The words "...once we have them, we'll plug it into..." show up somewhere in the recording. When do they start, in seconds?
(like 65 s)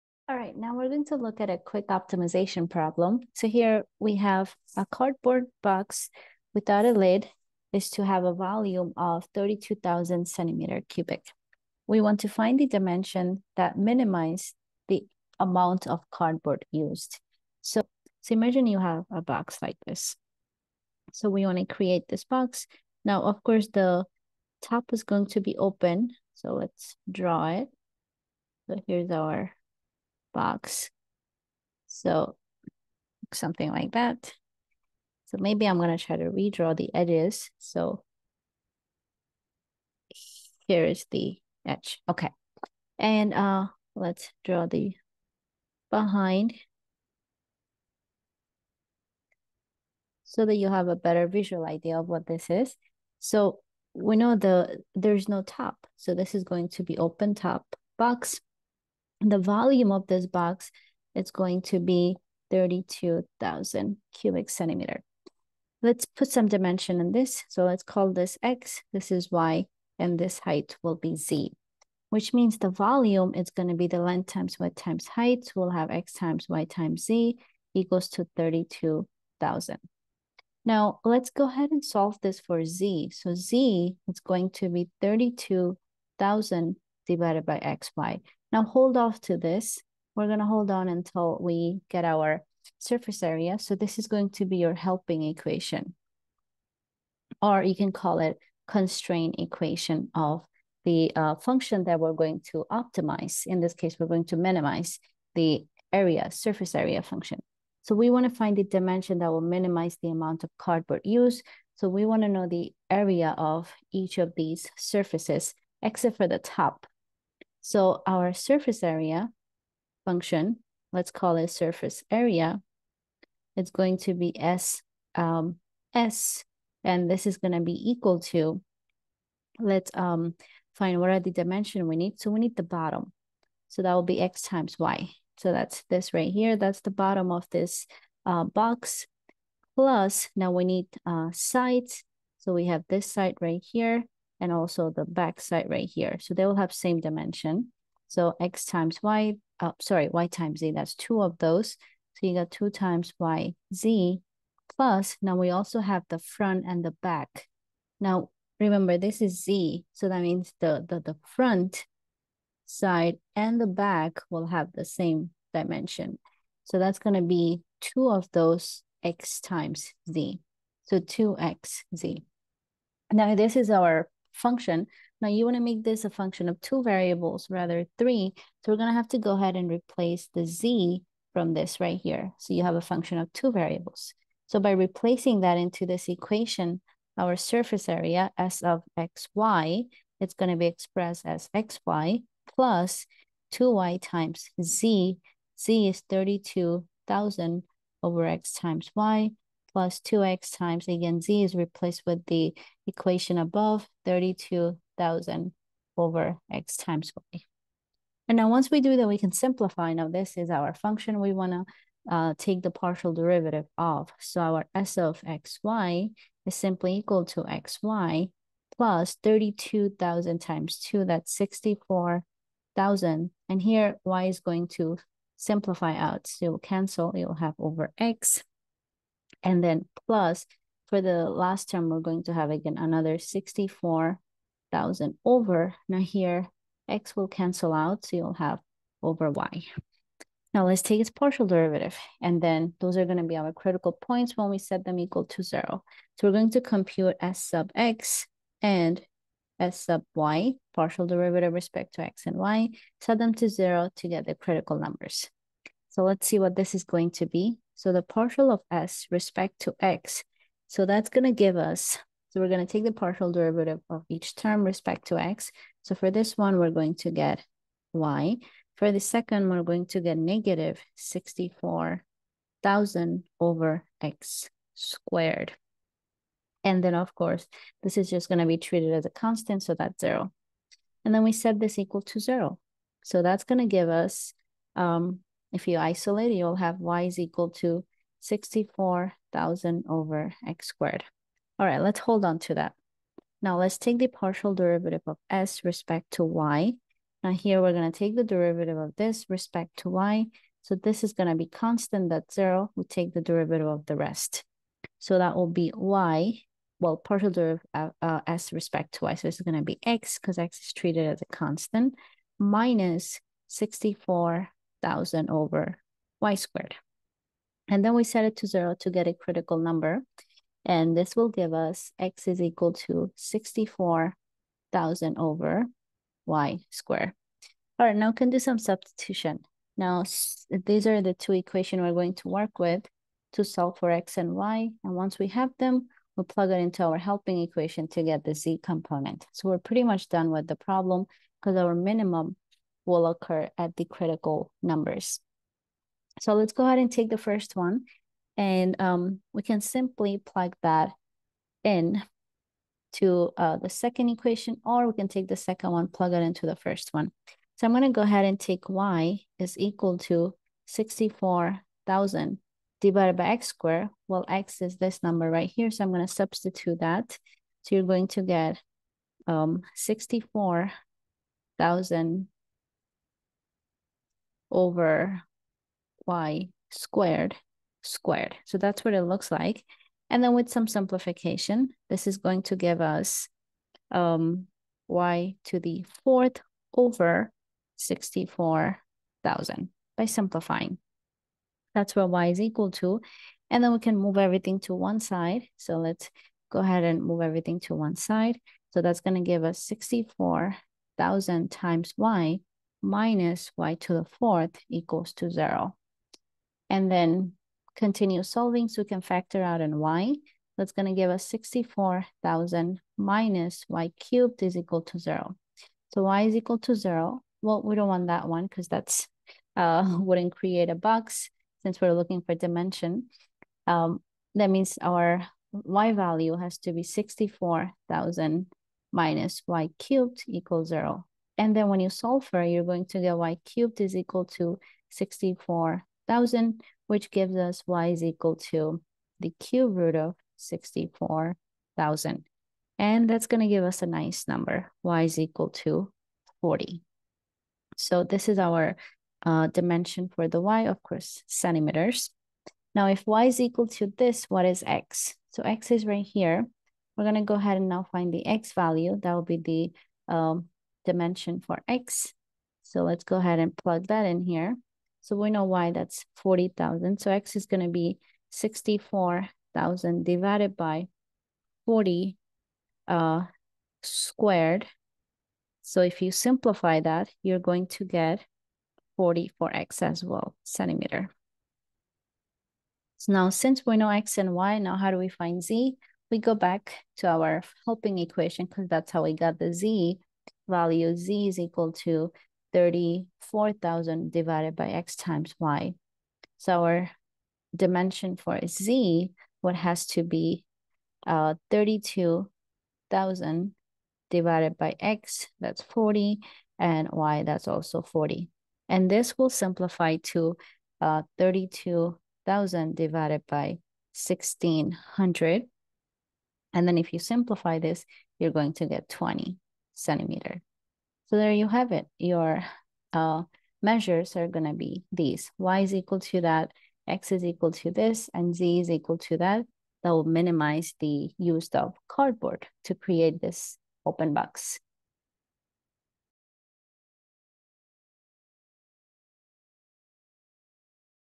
334 s.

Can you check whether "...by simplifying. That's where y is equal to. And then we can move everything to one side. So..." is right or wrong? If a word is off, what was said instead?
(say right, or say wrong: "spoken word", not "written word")
right.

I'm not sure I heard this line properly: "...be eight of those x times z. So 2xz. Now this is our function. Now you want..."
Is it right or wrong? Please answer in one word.
wrong.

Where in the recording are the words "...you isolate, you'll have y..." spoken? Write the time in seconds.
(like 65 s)
285 s.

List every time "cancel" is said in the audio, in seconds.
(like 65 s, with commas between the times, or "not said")
226 s, 237 s.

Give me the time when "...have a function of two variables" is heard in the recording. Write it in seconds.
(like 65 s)
182 s.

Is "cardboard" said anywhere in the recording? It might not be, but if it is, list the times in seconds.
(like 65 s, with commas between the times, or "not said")
4 s, 16 s, 110 s, 531 s.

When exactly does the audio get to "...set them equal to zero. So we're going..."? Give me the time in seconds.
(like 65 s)
244 s.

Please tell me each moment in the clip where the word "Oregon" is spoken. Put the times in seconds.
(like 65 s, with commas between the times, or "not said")
not said.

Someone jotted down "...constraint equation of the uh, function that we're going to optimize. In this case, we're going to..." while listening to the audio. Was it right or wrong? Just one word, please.
right.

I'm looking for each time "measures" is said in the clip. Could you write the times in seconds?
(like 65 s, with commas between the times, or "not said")
523 s.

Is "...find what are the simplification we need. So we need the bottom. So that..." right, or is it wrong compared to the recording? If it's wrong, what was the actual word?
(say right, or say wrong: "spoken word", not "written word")
wrong: "dimension", not "simplification".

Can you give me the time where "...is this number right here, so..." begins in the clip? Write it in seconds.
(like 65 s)
364 s.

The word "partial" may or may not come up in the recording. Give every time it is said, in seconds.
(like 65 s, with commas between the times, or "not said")
212 s, 241 s, 250 s, 258 s, 262 s, 294 s, 306 s.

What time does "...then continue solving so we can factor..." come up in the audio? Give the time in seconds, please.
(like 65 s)
406 s.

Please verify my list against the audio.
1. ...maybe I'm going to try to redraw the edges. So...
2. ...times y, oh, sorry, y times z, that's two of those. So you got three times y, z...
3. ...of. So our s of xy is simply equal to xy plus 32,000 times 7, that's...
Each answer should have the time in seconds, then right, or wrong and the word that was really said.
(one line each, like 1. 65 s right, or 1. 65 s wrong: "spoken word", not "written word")
1. 35 s right
2. 148 s wrong: "two", not "three"
3. 213 s wrong: "2", not "7".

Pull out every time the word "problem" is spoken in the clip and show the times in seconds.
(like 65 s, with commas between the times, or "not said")
2 s, 340 s.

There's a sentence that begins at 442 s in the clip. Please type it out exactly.
And that's going to give us a nice number, y is equal to 40.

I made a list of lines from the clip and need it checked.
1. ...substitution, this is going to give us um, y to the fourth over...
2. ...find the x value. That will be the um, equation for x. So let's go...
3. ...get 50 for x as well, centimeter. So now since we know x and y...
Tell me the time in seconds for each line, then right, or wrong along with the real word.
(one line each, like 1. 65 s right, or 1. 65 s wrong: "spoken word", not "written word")
1. 380 s wrong: "simplification", not "substitution"
2. 457 s wrong: "dimension", not "equation"
3. 477 s wrong: "40", not "50".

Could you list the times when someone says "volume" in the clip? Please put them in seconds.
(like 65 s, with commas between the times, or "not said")
8 s, 59 s, 72 s.